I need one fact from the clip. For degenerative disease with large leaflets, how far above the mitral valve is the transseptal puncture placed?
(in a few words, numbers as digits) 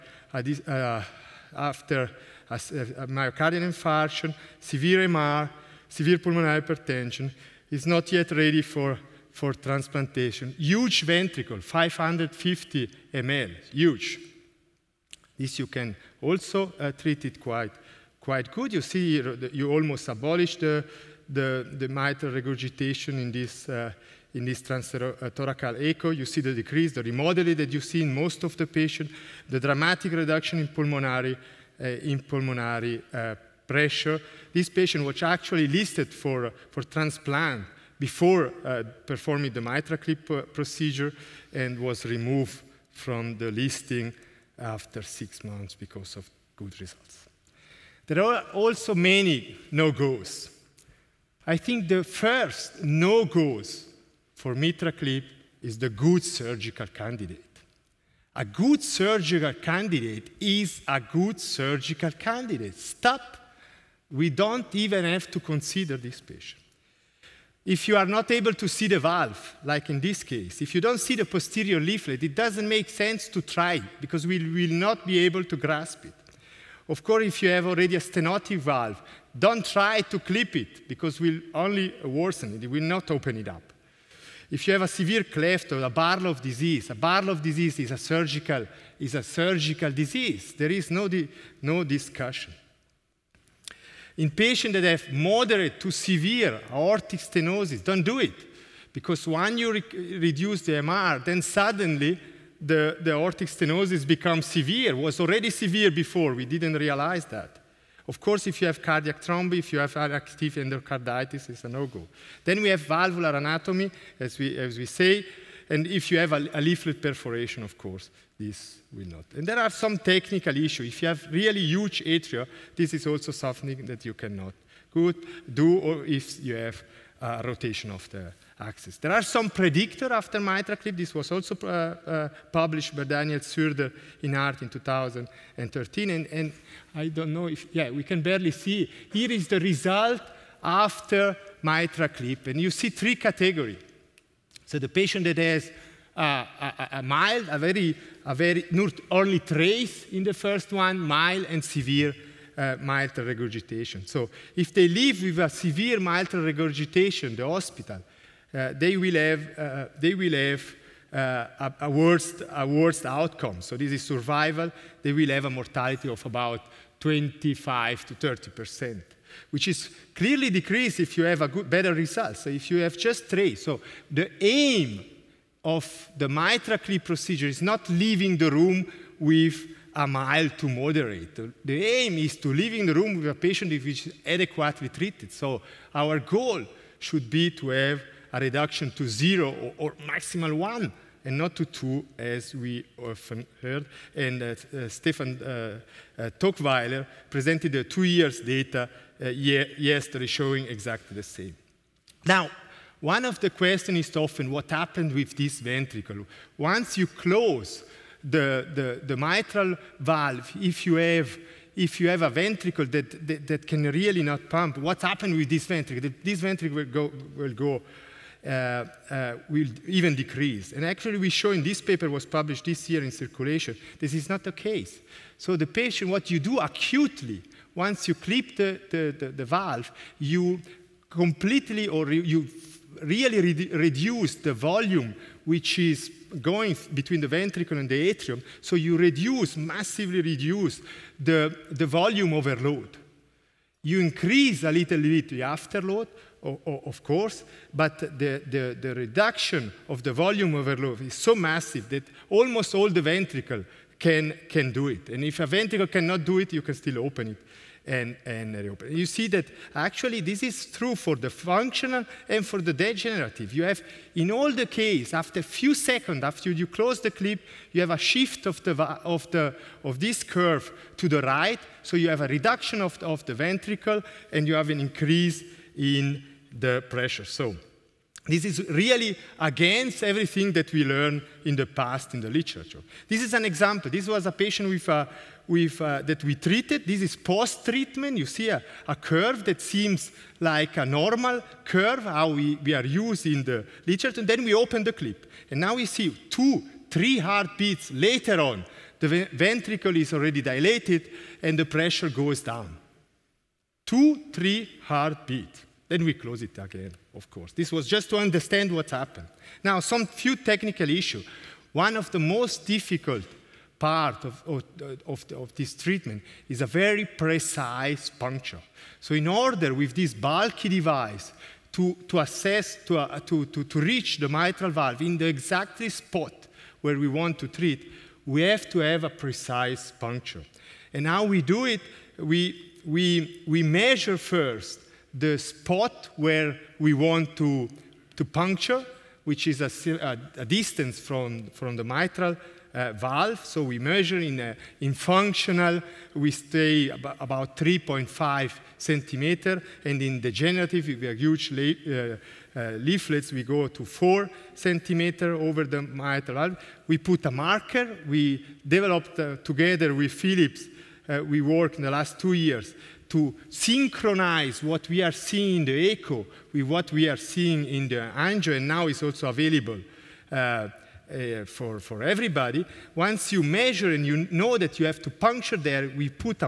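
4 cm.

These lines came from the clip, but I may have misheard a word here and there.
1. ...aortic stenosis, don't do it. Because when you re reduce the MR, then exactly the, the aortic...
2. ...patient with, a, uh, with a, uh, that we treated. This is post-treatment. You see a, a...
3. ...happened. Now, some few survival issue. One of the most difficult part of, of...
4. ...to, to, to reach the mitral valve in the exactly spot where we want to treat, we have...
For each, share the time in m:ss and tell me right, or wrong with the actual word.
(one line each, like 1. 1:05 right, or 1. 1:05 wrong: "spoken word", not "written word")
1. 1:36 wrong: "suddenly", not "exactly"
2. 4:44 right
3. 5:08 wrong: "technical", not "survival"
4. 5:23 right.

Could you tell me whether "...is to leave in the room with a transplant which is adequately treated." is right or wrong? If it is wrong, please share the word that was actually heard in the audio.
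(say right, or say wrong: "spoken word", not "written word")
wrong: "patient", not "transplant".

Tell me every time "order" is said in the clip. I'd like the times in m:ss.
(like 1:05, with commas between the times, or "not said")
5:19.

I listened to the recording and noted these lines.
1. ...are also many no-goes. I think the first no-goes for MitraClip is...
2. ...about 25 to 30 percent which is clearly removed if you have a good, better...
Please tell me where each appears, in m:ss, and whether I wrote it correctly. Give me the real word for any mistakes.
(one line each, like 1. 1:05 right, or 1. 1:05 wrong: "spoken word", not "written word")
1. 0:48 right
2. 2:46 wrong: "decreased", not "removed".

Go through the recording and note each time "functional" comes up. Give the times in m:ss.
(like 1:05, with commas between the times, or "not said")
4:21, 5:44.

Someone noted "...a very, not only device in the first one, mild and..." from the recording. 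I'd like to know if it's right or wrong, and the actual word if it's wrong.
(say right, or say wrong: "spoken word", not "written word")
wrong: "trace", not "device".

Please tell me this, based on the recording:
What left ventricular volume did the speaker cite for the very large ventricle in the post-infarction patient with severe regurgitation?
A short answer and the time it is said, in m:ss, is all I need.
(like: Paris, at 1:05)
550 ml, at 0:11.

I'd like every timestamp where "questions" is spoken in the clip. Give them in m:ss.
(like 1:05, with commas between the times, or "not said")
3:23.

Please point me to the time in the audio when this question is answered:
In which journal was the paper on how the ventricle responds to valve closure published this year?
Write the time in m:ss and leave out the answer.
3:43.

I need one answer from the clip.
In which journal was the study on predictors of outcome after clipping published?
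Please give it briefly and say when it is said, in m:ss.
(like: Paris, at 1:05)
Heart, at 2:14.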